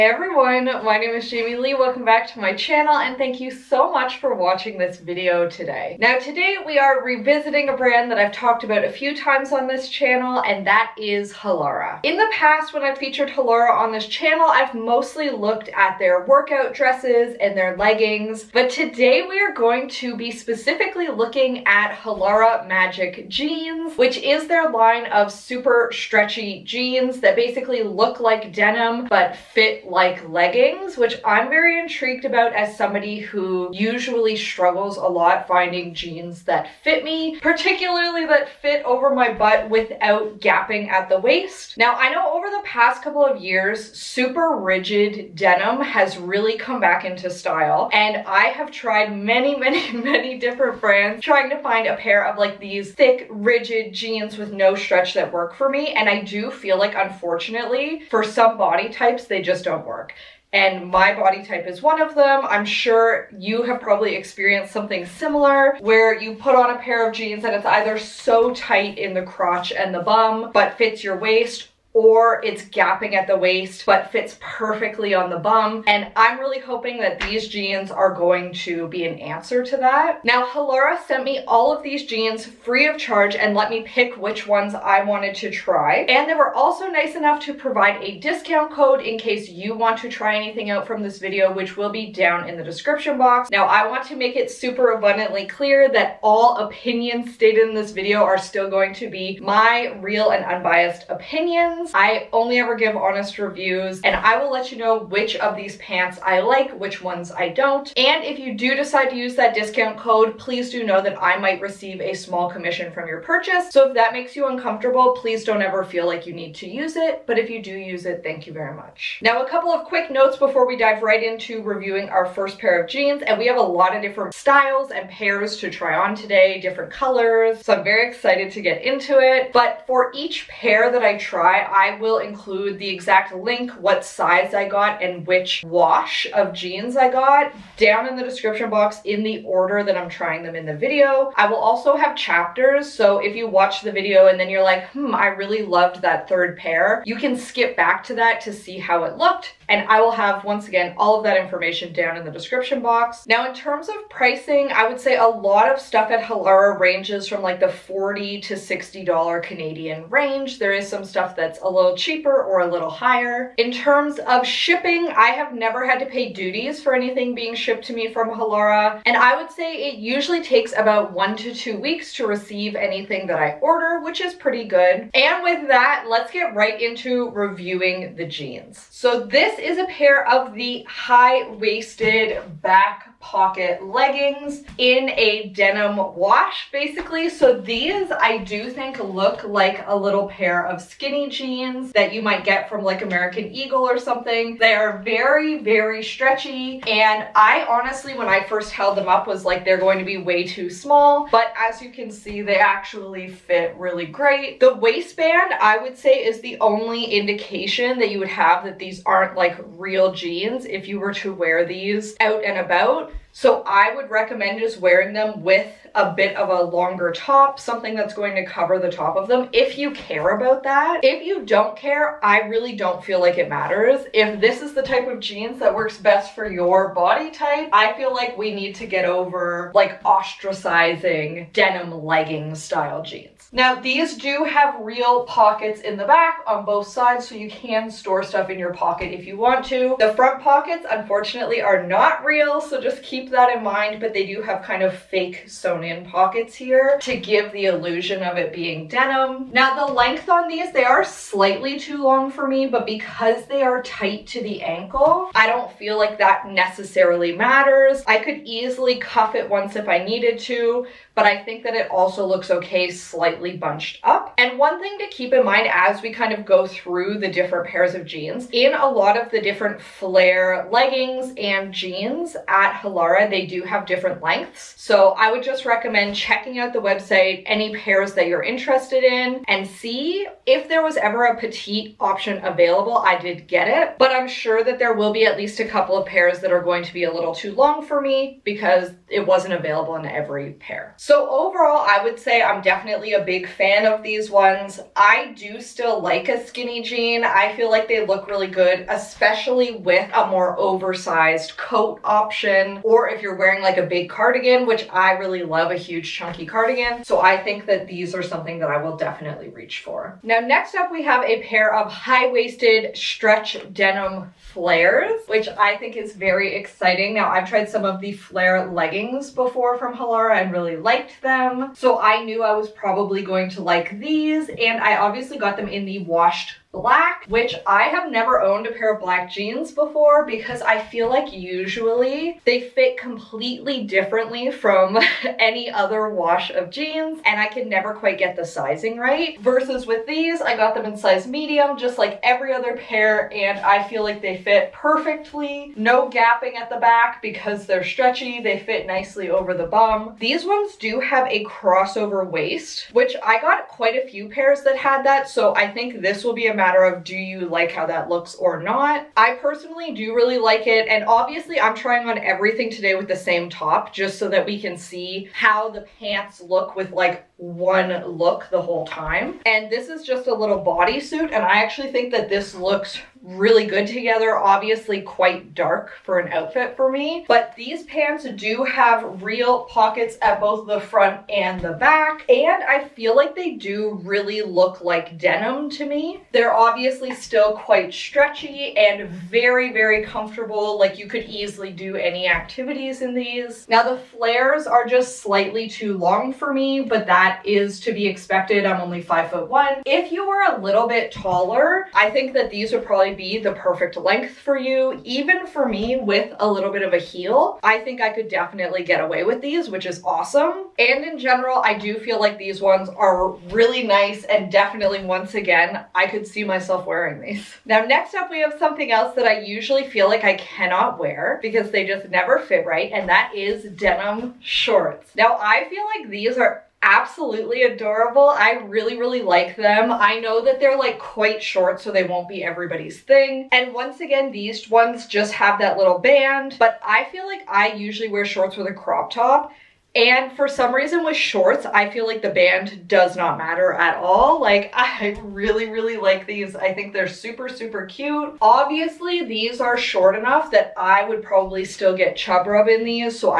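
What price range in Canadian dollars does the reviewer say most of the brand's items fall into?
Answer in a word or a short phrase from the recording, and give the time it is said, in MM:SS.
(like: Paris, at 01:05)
40 to 60 dollars, at 02:37.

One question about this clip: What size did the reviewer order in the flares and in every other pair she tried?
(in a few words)
medium.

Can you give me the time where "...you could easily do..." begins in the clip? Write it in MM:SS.
06:30.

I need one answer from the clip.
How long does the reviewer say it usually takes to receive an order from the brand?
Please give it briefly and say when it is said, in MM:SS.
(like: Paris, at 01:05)
1 to 2 weeks, at 02:51.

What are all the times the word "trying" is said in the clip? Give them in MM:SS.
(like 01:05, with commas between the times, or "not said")
00:51, 02:20, 06:01.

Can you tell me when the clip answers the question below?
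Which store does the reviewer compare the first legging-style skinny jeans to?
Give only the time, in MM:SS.
03:13.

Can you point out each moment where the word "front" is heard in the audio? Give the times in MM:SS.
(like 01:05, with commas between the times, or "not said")
04:00, 06:20.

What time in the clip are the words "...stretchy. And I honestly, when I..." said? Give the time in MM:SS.
03:16.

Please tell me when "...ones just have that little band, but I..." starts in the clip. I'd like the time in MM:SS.
07:14.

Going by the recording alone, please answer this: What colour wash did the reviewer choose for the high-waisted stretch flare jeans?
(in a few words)
washed black.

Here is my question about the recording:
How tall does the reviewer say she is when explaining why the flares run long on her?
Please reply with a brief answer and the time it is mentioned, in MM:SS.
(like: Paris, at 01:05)
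5 foot 1, at 06:39.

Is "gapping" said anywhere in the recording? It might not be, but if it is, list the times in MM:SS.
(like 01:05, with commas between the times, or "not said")
00:40, 01:12, 05:46.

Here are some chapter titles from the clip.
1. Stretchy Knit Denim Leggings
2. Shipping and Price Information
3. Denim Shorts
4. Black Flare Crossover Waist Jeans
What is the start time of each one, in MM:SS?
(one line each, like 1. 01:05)
1. 02:54
2. 01:58
3. 06:56
4. 05:09.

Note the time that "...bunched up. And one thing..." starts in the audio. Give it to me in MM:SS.
04:23.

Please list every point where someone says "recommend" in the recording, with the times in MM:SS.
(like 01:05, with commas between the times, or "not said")
03:34, 04:35.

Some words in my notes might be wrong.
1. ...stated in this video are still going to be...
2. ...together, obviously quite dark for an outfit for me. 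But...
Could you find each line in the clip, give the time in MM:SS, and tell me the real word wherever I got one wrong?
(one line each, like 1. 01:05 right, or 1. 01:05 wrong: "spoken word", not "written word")
1. 01:37 right
2. 06:13 right.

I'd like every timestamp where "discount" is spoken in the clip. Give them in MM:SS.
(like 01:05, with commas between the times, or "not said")
01:28, 01:49.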